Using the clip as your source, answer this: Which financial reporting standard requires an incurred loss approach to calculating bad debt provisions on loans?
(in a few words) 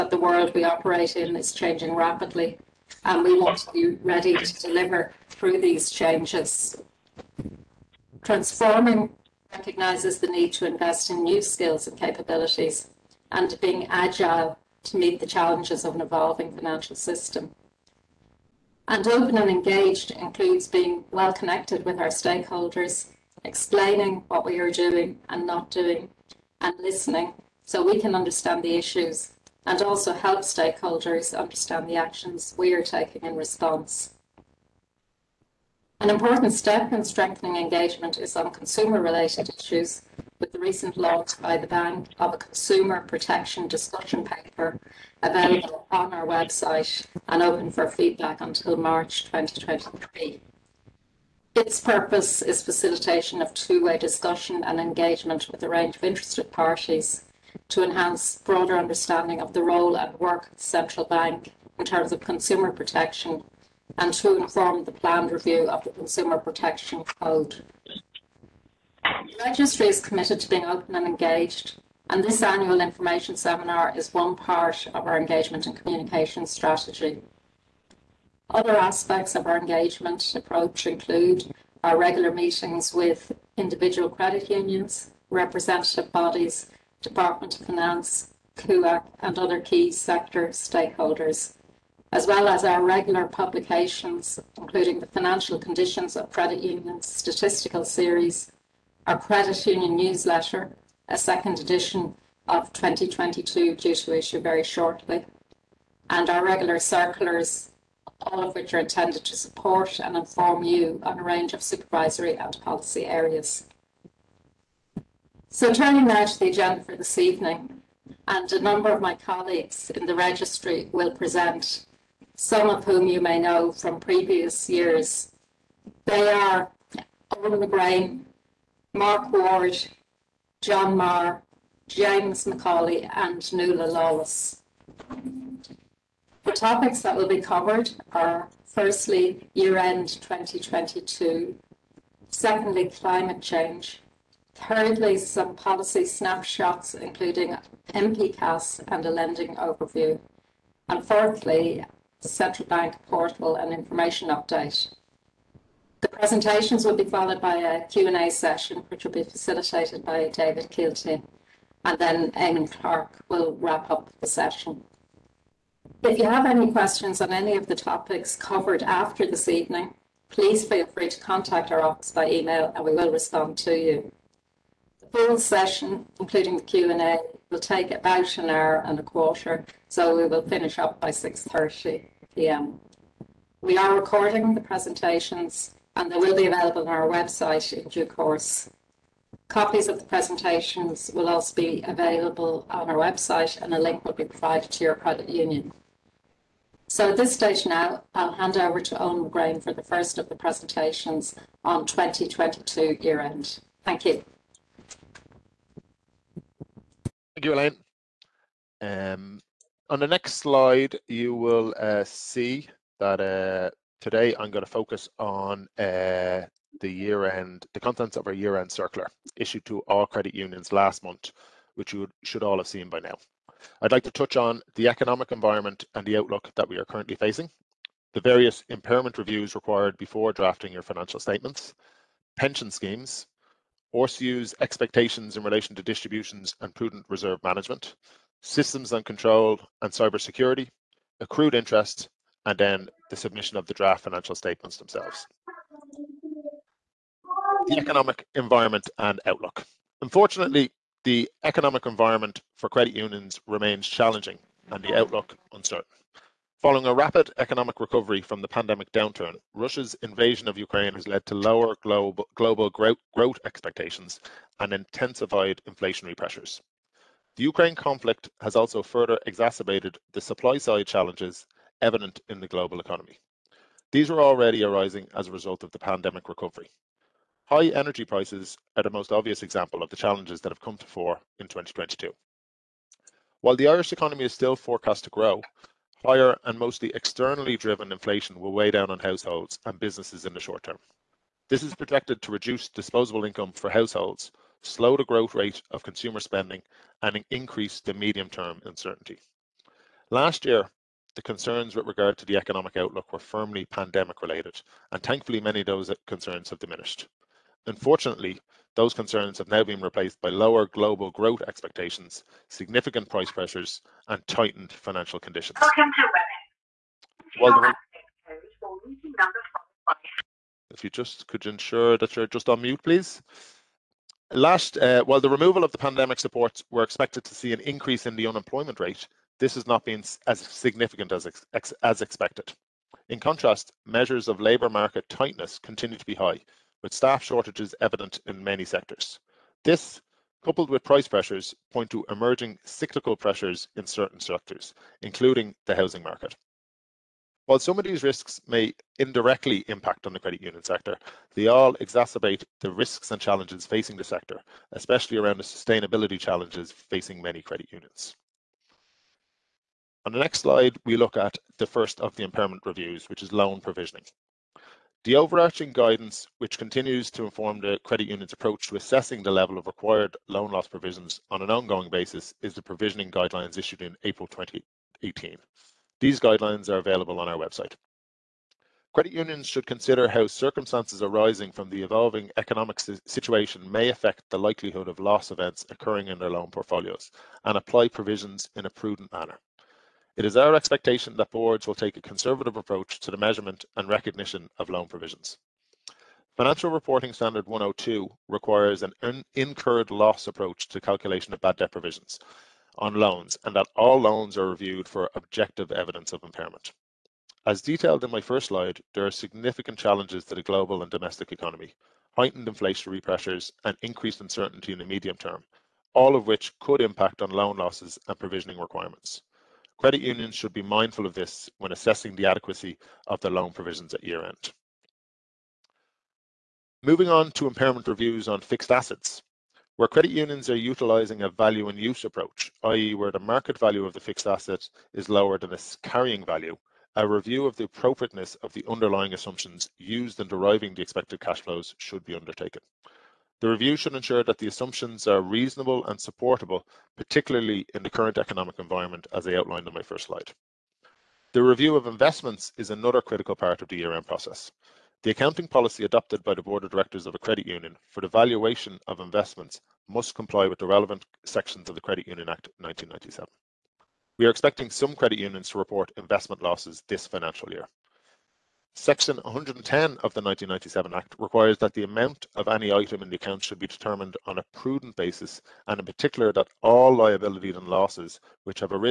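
Financial Reporting Standard 102.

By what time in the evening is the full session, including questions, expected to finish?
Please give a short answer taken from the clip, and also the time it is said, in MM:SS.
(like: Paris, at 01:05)
6:30 PM, at 03:01.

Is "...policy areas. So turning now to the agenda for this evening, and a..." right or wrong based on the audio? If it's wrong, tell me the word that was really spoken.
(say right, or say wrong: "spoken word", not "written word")
right.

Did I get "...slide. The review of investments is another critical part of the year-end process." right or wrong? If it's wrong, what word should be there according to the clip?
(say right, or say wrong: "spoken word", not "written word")
right.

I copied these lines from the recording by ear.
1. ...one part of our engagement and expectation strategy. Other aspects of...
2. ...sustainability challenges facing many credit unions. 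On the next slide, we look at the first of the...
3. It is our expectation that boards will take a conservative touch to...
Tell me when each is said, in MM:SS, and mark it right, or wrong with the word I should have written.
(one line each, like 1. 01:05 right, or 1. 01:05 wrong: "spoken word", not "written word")
1. 01:14 wrong: "communication", not "expectation"
2. 05:55 right
3. 06:30 wrong: "approach", not "touch".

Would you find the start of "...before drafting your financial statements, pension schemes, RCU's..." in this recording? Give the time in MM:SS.
03:49.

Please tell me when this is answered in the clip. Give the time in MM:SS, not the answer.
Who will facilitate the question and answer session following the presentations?
02:40.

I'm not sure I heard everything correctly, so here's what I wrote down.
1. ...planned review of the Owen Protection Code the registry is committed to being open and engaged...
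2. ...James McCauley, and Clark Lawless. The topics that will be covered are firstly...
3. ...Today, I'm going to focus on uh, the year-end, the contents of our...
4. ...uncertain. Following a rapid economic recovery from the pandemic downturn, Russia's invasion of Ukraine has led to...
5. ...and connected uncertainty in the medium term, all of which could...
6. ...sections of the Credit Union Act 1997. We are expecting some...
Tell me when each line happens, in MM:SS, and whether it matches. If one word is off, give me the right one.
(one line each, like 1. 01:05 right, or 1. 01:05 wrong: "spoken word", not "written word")
1. 01:04 wrong: "Consumer", not "Owen"
2. 02:11 wrong: "Nuala", not "Clark"
3. 03:34 right
4. 04:15 right
5. 06:53 wrong: "increased", not "connected"
6. 07:41 right.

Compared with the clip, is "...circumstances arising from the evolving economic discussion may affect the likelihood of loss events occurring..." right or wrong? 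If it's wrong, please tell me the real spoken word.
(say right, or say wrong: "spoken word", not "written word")
wrong: "situation", not "discussion".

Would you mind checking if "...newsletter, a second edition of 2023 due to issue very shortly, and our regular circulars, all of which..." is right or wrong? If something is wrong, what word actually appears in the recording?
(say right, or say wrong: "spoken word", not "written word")
wrong: "2022", not "2023".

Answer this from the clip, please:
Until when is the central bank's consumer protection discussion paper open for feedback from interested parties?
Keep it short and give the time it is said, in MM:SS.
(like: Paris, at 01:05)
March 2023, at 00:48.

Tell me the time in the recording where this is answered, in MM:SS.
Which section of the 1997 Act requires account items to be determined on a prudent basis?
07:48.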